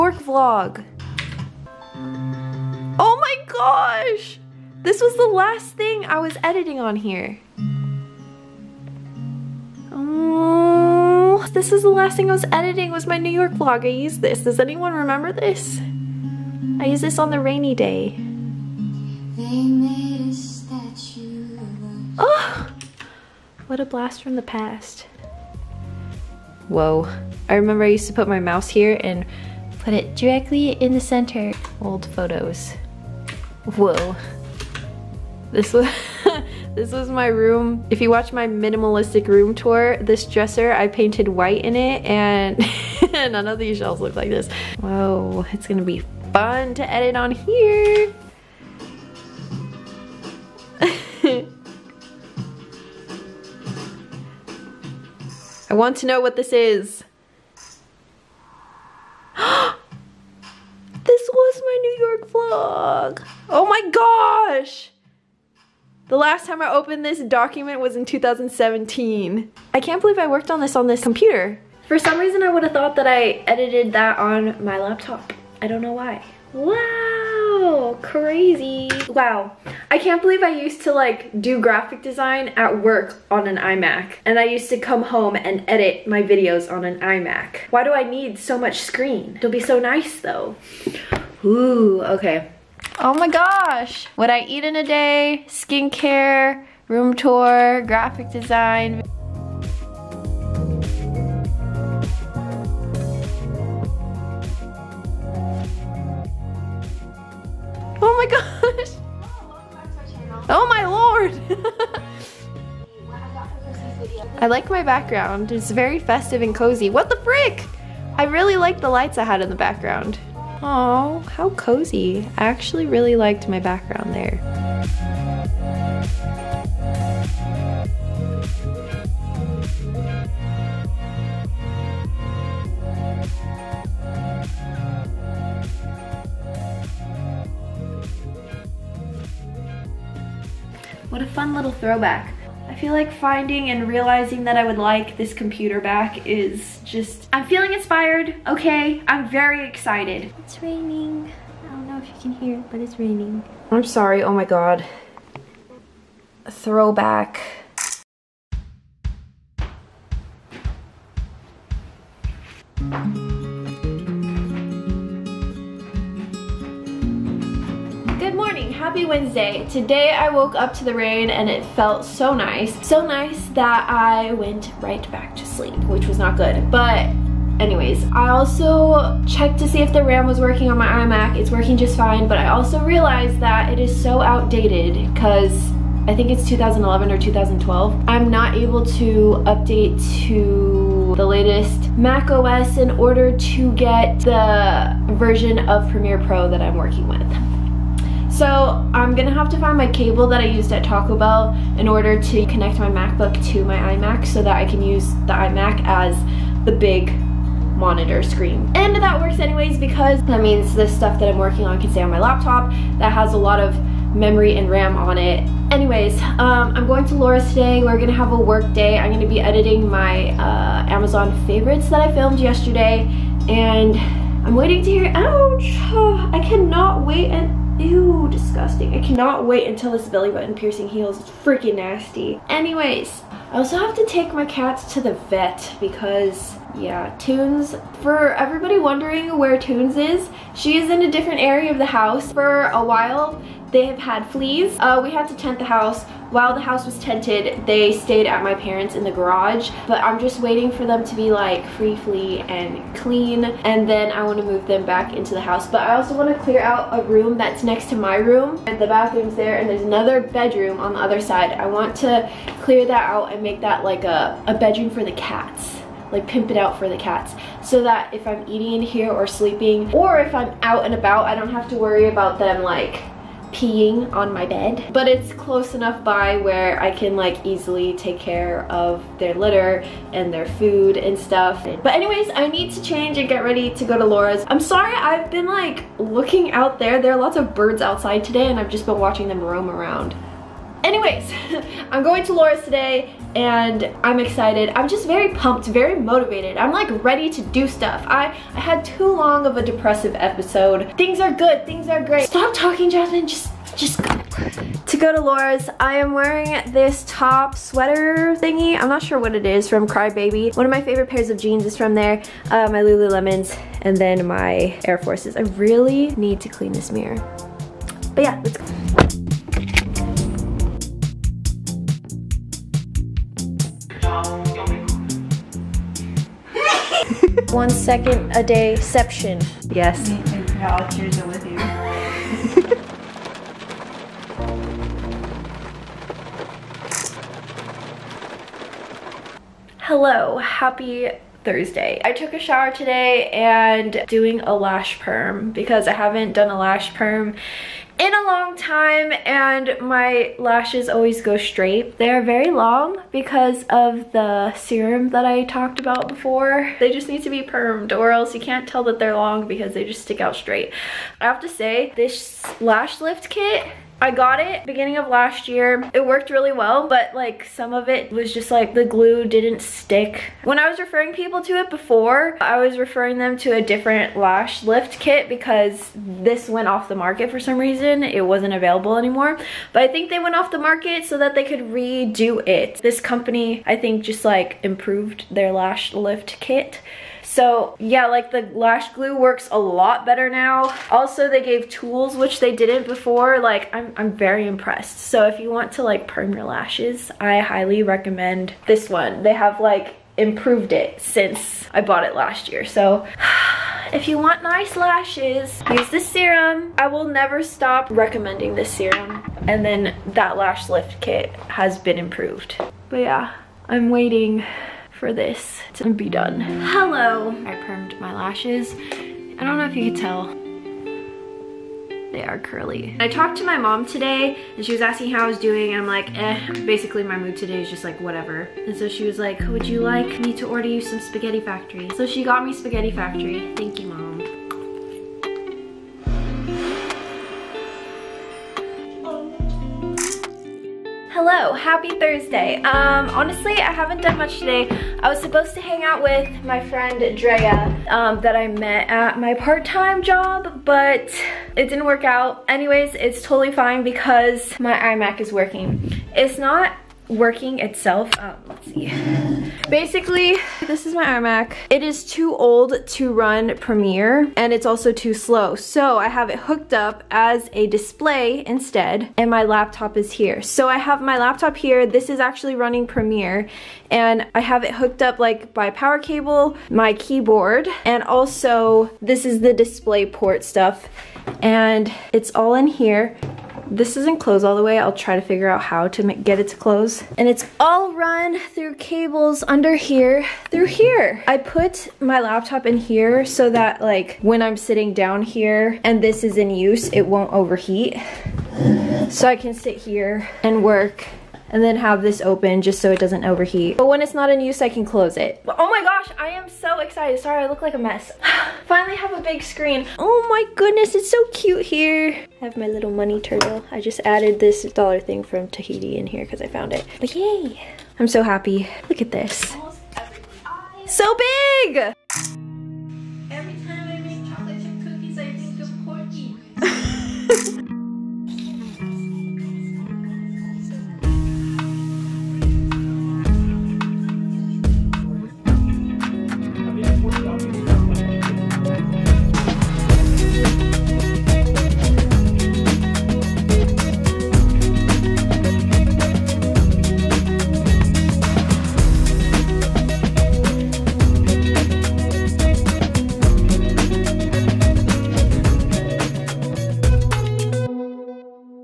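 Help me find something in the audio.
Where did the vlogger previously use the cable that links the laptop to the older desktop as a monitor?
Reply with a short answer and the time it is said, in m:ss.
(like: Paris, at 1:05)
Taco Bell, at 3:20.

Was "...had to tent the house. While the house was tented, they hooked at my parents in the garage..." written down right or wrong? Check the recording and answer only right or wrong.
wrong.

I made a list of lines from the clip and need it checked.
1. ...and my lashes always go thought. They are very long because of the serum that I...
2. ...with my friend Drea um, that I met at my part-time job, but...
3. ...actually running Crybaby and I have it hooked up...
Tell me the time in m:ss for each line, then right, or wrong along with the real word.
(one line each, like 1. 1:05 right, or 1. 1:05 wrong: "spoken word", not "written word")
1. 5:49 wrong: "straight", not "thought"
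2. 7:26 right
3. 7:52 wrong: "Premiere", not "Crybaby".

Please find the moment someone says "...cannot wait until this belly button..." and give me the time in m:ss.
3:48.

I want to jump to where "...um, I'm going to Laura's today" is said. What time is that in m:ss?
3:36.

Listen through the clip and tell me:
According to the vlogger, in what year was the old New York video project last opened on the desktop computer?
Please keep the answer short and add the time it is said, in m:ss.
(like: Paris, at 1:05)
2017, at 1:08.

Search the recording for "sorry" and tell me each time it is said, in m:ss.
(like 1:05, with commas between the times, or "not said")
2:33, 4:44, 8:27.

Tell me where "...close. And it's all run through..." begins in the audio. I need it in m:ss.
8:06.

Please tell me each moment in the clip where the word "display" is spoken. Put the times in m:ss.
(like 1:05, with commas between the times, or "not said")
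7:47, 7:59.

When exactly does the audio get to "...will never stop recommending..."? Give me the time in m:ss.
6:46.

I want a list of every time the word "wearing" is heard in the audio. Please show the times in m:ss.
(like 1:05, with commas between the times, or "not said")
5:06.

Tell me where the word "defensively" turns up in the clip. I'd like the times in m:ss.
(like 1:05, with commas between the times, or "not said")
not said.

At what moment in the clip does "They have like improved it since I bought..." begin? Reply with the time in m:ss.
6:39.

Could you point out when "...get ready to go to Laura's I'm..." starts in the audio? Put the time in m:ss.
4:43.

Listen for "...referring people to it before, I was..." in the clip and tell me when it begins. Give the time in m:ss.
6:10.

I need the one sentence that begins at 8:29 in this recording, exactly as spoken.
Oh my goodness, it's so cute here.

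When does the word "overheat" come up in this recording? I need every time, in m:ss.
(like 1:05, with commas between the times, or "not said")
8:17, 8:23.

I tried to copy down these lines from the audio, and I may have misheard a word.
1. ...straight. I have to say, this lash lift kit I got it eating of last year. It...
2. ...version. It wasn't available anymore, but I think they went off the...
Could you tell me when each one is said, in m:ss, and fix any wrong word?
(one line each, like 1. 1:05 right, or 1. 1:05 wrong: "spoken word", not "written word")
1. 6:00 wrong: "beginning", not "eating"
2. 6:17 wrong: "reason", not "version".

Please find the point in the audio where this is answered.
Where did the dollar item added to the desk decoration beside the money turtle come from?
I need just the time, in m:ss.
8:35.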